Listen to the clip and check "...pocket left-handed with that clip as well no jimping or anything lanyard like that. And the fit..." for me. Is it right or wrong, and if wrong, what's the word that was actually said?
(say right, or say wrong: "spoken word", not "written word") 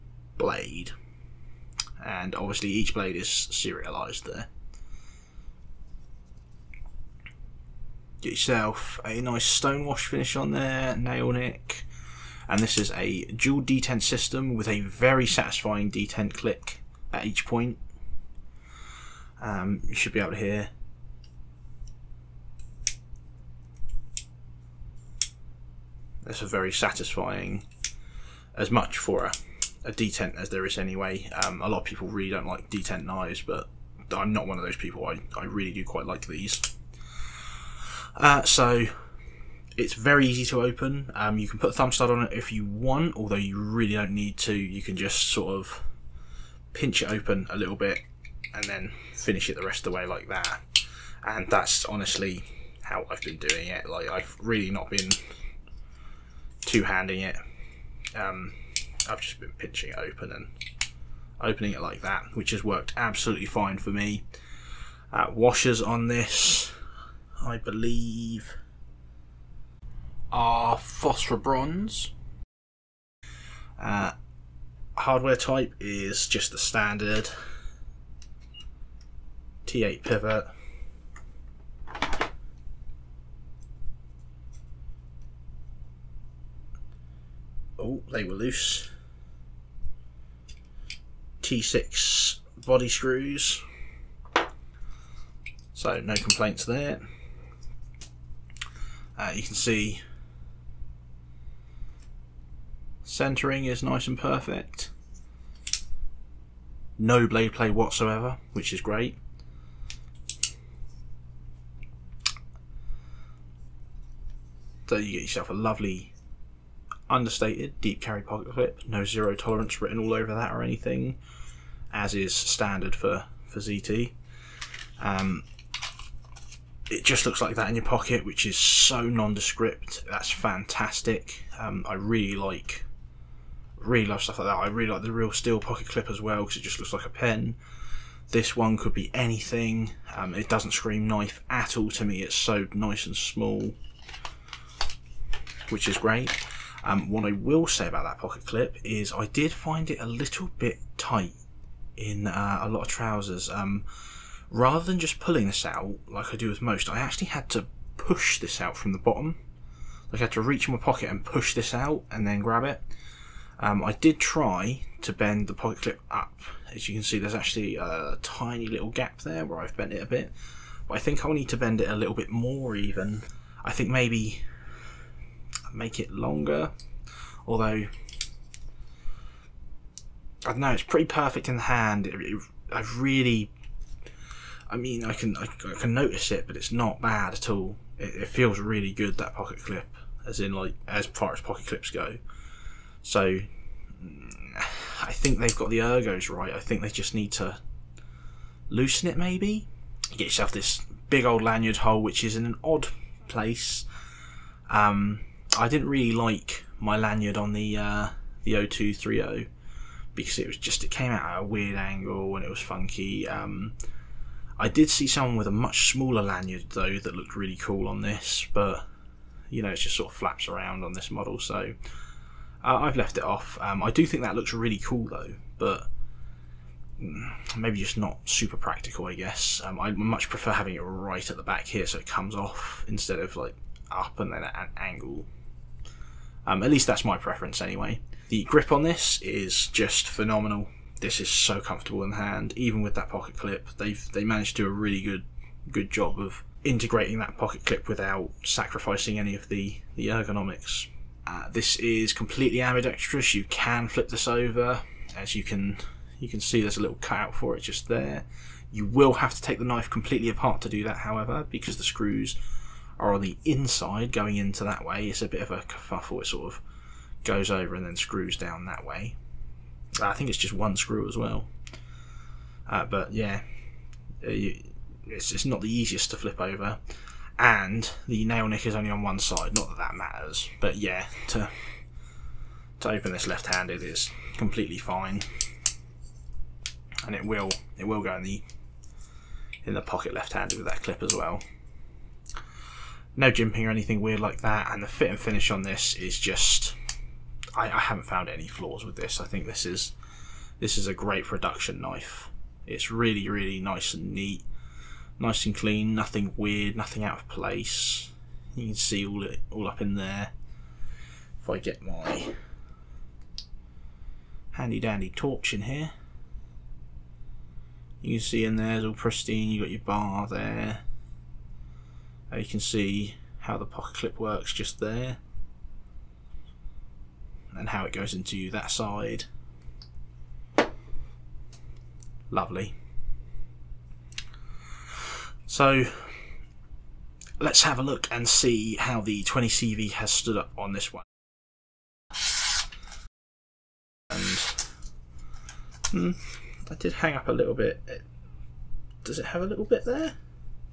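wrong: "weird", not "lanyard".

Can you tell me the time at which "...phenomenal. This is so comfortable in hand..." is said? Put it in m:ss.
4:00.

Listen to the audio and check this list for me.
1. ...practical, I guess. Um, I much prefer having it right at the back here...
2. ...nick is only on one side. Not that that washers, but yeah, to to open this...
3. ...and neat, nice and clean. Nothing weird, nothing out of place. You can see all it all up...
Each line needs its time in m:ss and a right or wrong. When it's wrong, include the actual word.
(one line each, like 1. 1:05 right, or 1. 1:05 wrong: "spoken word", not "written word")
1. 3:48 right
2. 4:38 wrong: "matters", not "washers"
3. 5:03 right.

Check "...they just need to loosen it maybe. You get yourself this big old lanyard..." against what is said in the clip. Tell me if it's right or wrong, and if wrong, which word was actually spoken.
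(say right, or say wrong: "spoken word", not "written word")
right.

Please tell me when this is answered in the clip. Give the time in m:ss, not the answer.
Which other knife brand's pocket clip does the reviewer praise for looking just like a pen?
2:15.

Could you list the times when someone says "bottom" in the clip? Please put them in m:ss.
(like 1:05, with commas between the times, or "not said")
2:38.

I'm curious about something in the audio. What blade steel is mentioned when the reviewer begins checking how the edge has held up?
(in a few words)
20CV.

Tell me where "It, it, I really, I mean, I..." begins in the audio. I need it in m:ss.
3:02.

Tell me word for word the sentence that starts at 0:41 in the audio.
Um, you can put a thumb stud on it if you want, although you really don't need to.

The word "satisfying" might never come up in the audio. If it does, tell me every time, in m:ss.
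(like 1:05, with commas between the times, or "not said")
0:15, 0:26.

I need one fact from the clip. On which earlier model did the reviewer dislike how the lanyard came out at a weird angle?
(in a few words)
0230.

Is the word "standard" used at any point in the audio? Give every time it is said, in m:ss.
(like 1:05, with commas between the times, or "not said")
1:16, 2:02.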